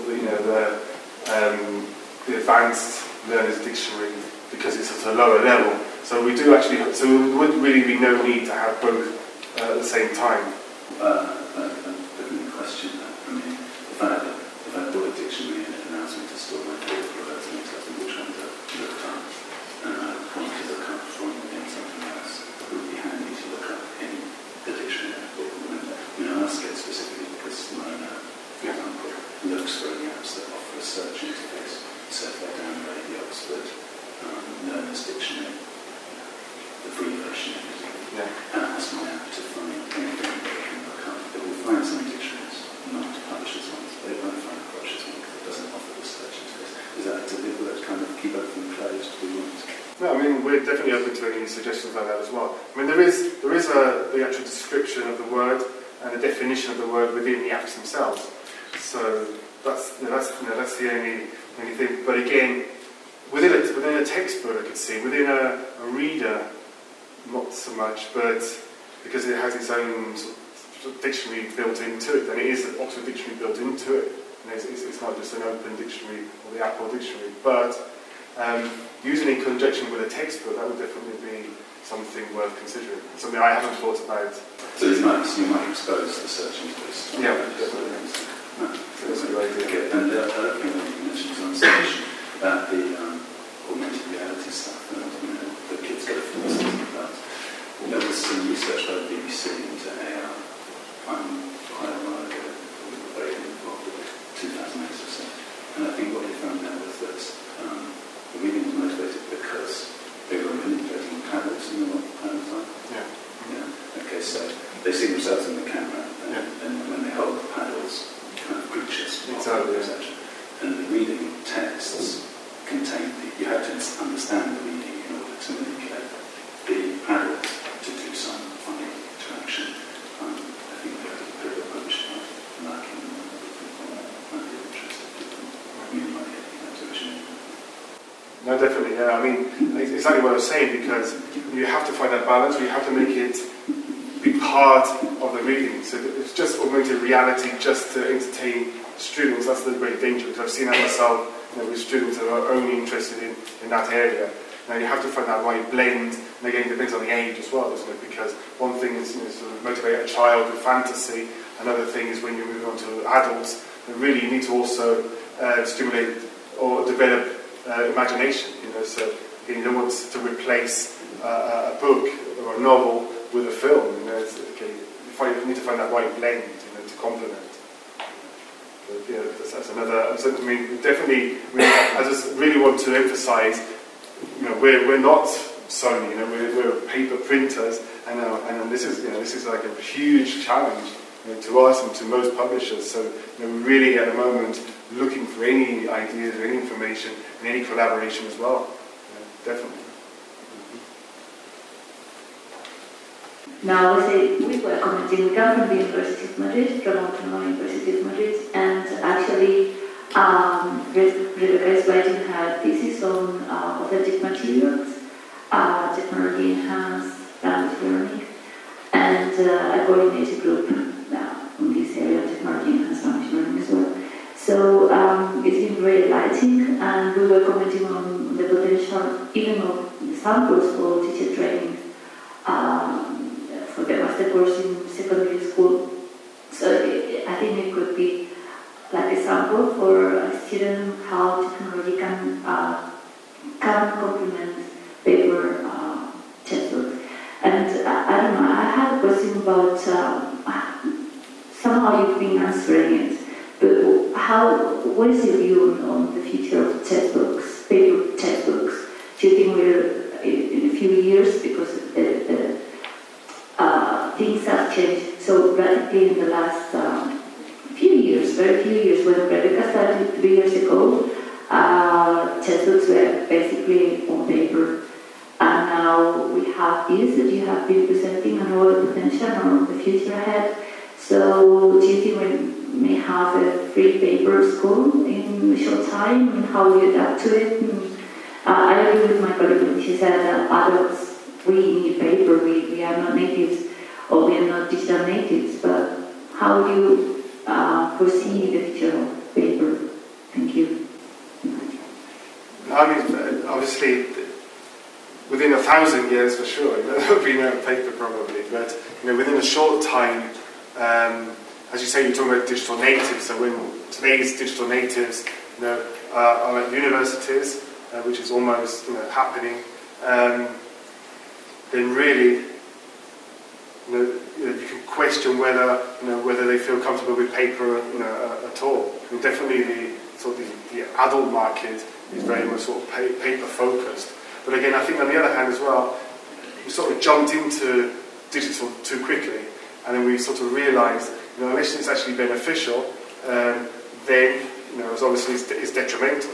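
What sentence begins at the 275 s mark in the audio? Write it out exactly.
And now we have this that you have been presenting and all the potential and the future ahead.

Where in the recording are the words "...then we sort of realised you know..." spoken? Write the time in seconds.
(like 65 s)
339 s.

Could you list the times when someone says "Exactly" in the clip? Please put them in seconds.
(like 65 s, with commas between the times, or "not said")
119 s.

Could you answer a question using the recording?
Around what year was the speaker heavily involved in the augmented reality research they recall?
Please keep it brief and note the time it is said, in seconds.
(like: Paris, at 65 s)
2008, at 104 s.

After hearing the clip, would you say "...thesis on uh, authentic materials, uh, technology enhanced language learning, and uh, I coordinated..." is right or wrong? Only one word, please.
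right.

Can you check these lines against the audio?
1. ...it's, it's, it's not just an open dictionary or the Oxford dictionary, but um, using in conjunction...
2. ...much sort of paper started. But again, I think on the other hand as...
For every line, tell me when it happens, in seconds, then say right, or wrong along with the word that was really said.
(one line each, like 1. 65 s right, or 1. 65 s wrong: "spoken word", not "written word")
1. 74 s wrong: "Apple", not "Oxford"
2. 332 s wrong: "focused", not "started".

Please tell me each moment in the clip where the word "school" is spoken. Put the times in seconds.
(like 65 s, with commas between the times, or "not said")
235 s, 284 s.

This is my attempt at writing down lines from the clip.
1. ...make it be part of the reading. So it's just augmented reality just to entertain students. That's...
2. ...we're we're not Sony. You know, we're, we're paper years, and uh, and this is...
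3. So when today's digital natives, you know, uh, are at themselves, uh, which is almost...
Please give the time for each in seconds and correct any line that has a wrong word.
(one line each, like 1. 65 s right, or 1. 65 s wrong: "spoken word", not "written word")
1. 142 s right
2. 184 s wrong: "printers", not "years"
3. 313 s wrong: "universities", not "themselves".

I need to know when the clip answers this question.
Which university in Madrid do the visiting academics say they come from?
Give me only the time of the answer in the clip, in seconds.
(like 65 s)
206 s.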